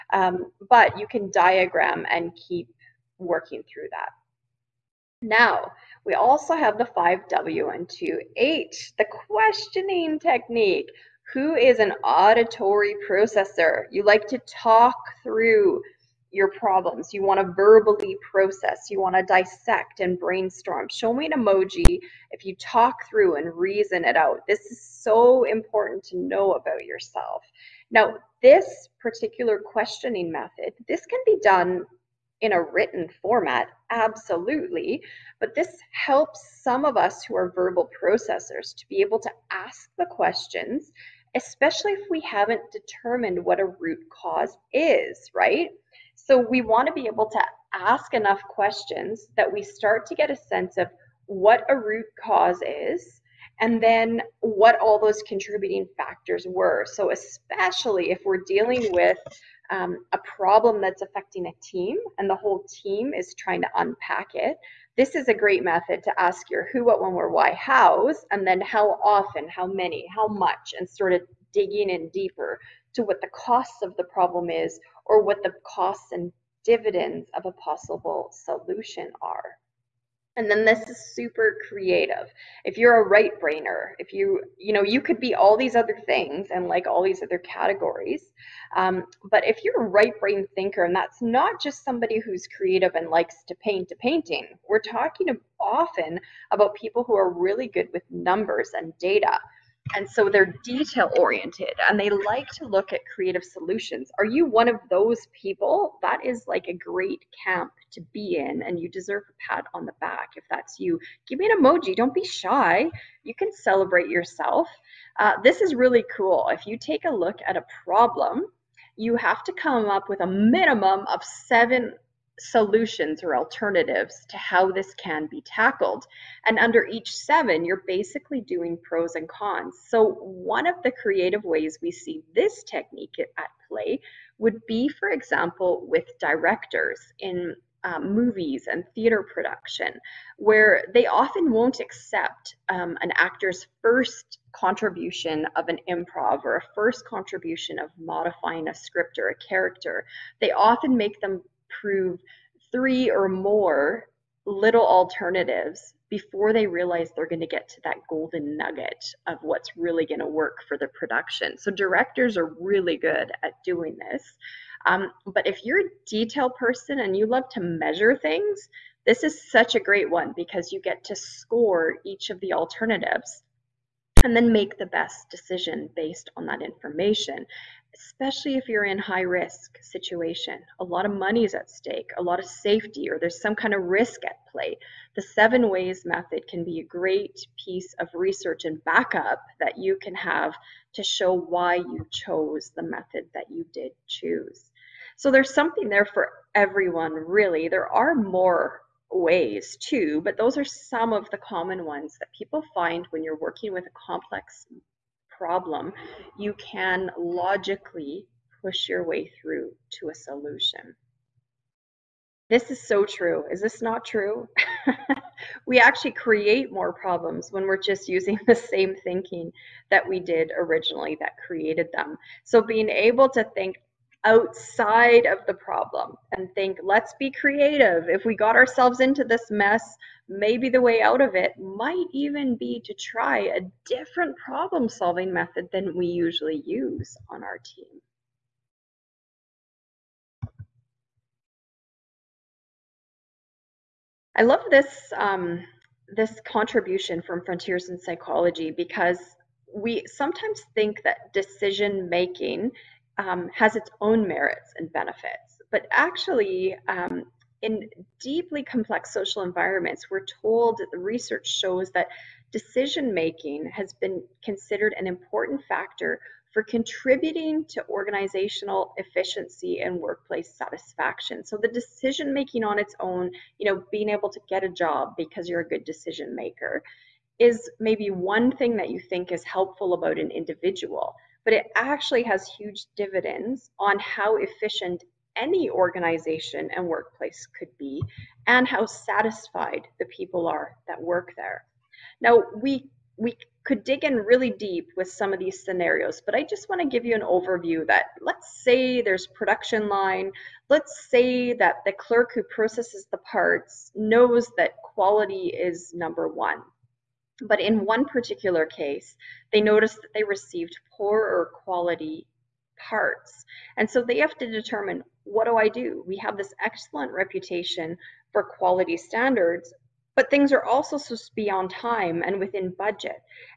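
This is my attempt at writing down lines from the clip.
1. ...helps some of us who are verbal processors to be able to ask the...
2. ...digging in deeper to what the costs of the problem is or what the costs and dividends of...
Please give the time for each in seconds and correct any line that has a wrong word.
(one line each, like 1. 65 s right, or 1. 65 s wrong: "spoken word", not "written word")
1. 35 s right
2. 71 s right.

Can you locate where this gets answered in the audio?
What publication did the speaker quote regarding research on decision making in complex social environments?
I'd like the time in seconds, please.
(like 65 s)
247 s.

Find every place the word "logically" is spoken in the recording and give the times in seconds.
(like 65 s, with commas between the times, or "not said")
207 s.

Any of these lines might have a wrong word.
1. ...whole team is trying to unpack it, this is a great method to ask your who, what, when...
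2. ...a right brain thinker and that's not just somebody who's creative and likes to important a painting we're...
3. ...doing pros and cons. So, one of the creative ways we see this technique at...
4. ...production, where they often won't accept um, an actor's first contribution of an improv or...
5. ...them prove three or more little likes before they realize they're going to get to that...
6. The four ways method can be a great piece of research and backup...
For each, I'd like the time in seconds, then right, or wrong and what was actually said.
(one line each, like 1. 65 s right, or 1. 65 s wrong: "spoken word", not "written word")
1. 62 s right
2. 89 s wrong: "paint", not "important"
3. 128 s right
4. 139 s right
5. 151 s wrong: "alternatives", not "likes"
6. 185 s wrong: "seven", not "four".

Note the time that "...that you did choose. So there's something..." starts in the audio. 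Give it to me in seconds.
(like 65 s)
193 s.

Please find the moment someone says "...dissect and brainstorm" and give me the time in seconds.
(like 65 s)
19 s.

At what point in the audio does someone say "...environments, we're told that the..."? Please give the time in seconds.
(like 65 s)
259 s.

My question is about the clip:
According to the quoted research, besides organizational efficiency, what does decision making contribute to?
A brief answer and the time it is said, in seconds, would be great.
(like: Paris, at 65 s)
Workplace satisfaction, at 269 s.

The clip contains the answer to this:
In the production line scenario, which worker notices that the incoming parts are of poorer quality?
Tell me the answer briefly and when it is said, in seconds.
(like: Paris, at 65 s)
The clerk, at 301 s.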